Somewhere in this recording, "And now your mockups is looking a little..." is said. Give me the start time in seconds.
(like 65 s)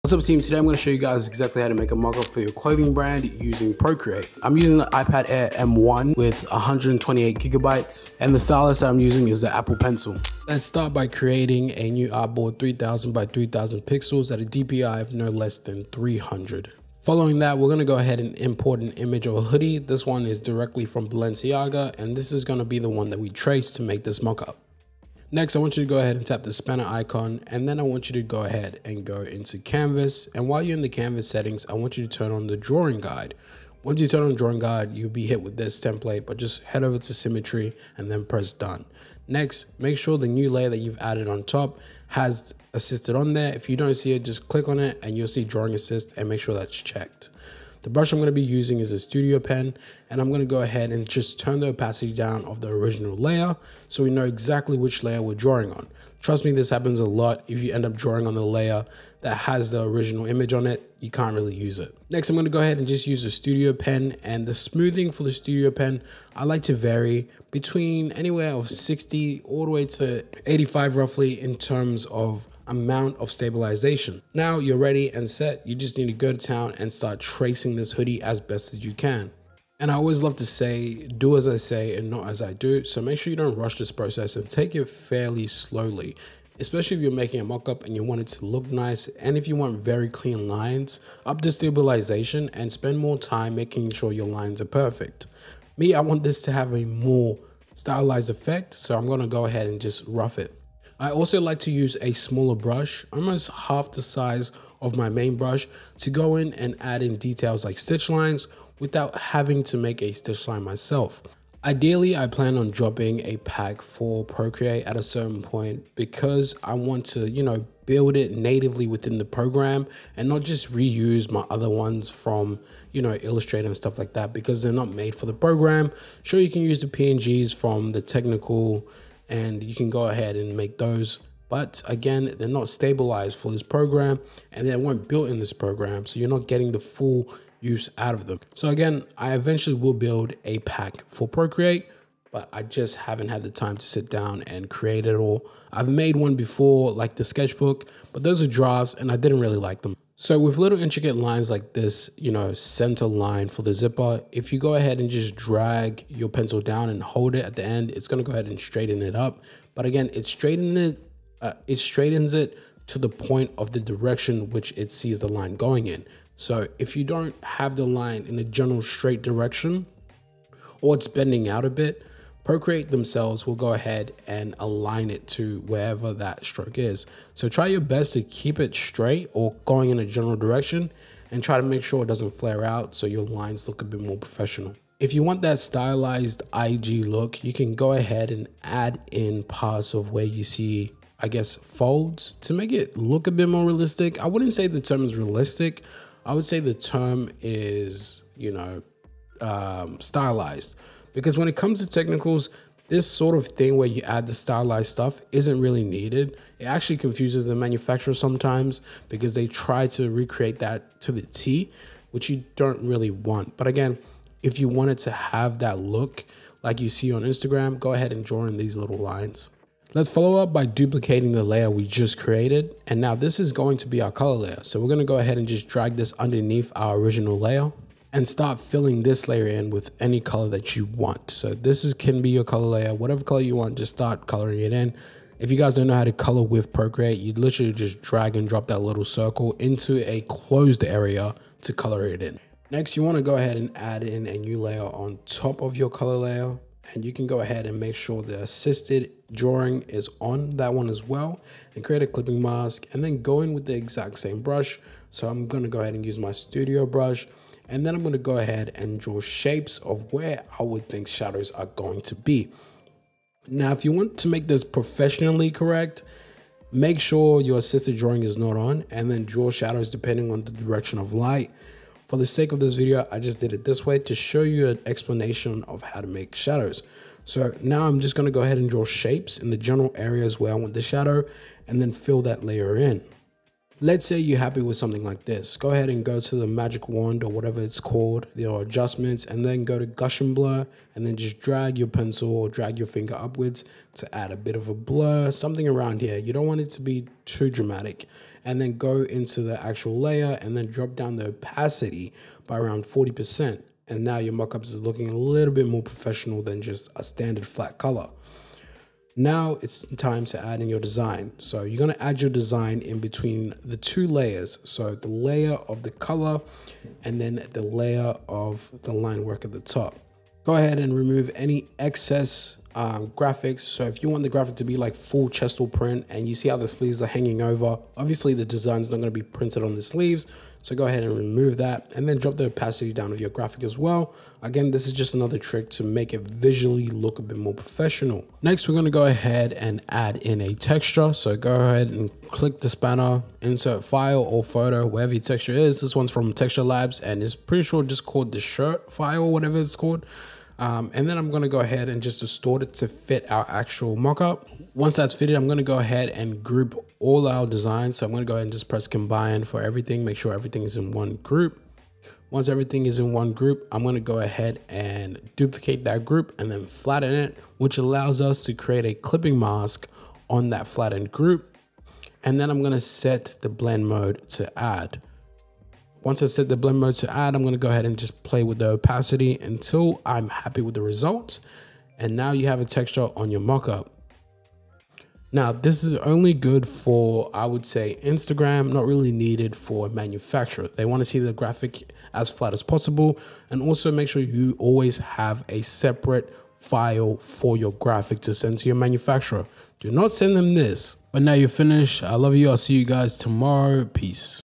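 303 s.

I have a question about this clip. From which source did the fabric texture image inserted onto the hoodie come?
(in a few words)
Texture Labs.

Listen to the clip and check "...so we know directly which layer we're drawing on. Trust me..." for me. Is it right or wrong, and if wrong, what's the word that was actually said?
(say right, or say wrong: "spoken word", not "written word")
wrong: "exactly", not "directly".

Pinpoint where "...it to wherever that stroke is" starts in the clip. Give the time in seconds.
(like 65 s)
175 s.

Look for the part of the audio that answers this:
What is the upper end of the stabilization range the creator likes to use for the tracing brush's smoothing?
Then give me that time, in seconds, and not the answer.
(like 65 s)
70 s.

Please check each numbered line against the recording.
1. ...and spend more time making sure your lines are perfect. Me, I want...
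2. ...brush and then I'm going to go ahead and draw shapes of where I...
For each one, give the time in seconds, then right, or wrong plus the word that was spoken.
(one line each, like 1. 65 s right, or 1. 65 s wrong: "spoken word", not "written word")
1. 92 s right
2. 256 s right.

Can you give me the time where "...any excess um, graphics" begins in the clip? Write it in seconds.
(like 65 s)
321 s.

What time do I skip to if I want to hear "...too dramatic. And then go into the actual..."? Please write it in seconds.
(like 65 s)
297 s.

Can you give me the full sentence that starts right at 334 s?
Again, this is just another trick to make it visually look a bit more professional.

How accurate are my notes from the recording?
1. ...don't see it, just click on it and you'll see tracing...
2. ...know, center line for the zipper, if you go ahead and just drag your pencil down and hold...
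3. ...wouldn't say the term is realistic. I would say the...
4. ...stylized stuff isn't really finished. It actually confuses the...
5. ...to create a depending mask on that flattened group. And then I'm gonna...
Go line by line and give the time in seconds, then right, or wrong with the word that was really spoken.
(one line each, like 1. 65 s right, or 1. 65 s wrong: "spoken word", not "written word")
1. 43 s wrong: "drawing", not "tracing"
2. 152 s right
3. 194 s right
4. 204 s wrong: "needed", not "finished"
5. 368 s wrong: "clipping", not "depending".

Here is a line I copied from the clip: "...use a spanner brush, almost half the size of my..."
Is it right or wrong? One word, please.
wrong.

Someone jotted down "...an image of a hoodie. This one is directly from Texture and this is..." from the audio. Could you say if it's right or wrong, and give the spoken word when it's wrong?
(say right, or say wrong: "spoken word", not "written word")
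wrong: "Balenciaga", not "Texture".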